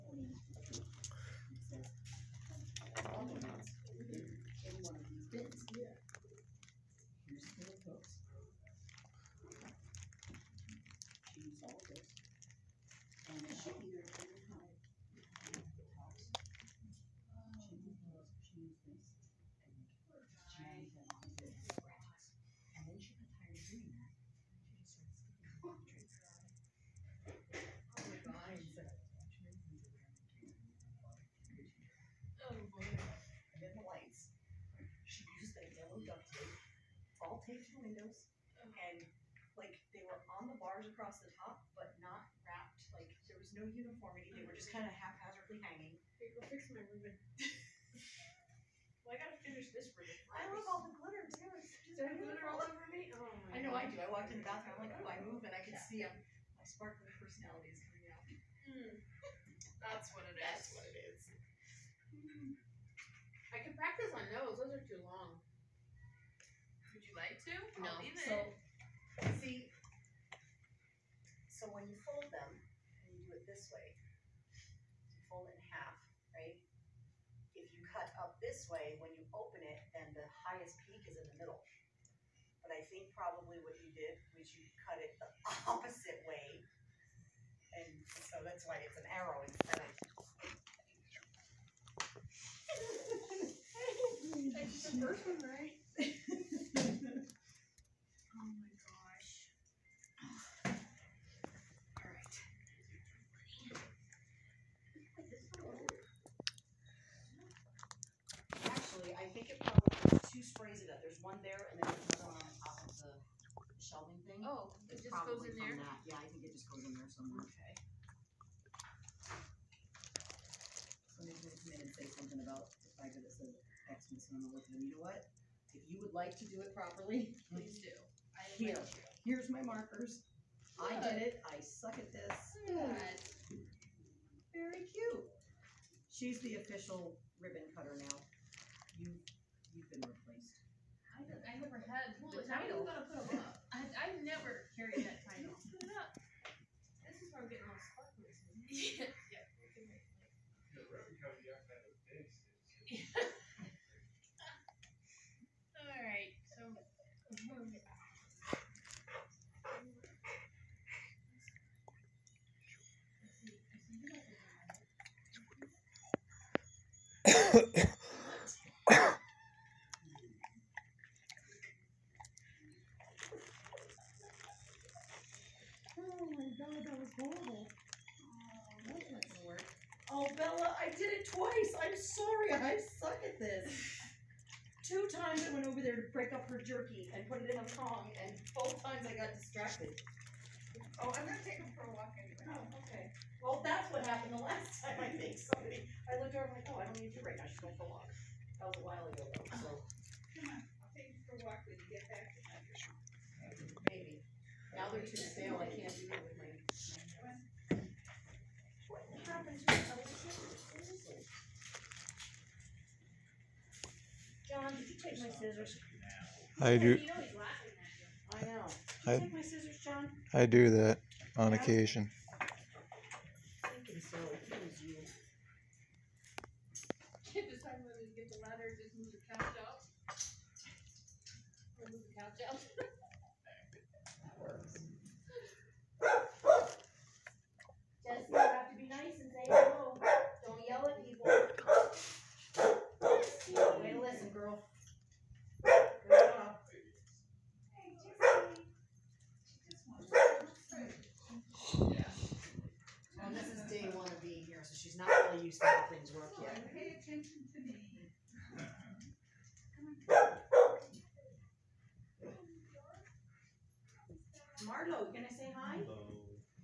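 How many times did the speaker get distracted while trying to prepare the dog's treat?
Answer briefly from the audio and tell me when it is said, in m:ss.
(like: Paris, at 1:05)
2, at 3:04.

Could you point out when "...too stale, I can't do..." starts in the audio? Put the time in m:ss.
3:25.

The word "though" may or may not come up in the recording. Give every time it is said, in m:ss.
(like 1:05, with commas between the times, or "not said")
3:19.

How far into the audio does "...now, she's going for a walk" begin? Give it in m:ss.
3:17.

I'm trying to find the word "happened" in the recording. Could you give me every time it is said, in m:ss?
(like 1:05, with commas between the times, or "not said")
3:14, 3:29.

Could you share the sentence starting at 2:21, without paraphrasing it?
I, I never had well, the The title.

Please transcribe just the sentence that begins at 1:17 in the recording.
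If you cut up this way, when you open it, then the highest peak is in the middle.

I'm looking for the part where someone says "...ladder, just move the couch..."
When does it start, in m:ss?
3:48.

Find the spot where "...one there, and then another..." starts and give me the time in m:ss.
1:51.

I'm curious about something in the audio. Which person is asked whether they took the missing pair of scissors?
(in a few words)
John.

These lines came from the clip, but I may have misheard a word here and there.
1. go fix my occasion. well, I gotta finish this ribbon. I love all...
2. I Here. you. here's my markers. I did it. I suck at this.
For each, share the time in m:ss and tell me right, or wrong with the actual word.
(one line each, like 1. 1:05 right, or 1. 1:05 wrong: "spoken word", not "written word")
1. 0:46 wrong: "ribbon", not "occasion"
2. 2:08 right.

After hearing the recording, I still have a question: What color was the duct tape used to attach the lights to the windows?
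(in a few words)
yellow.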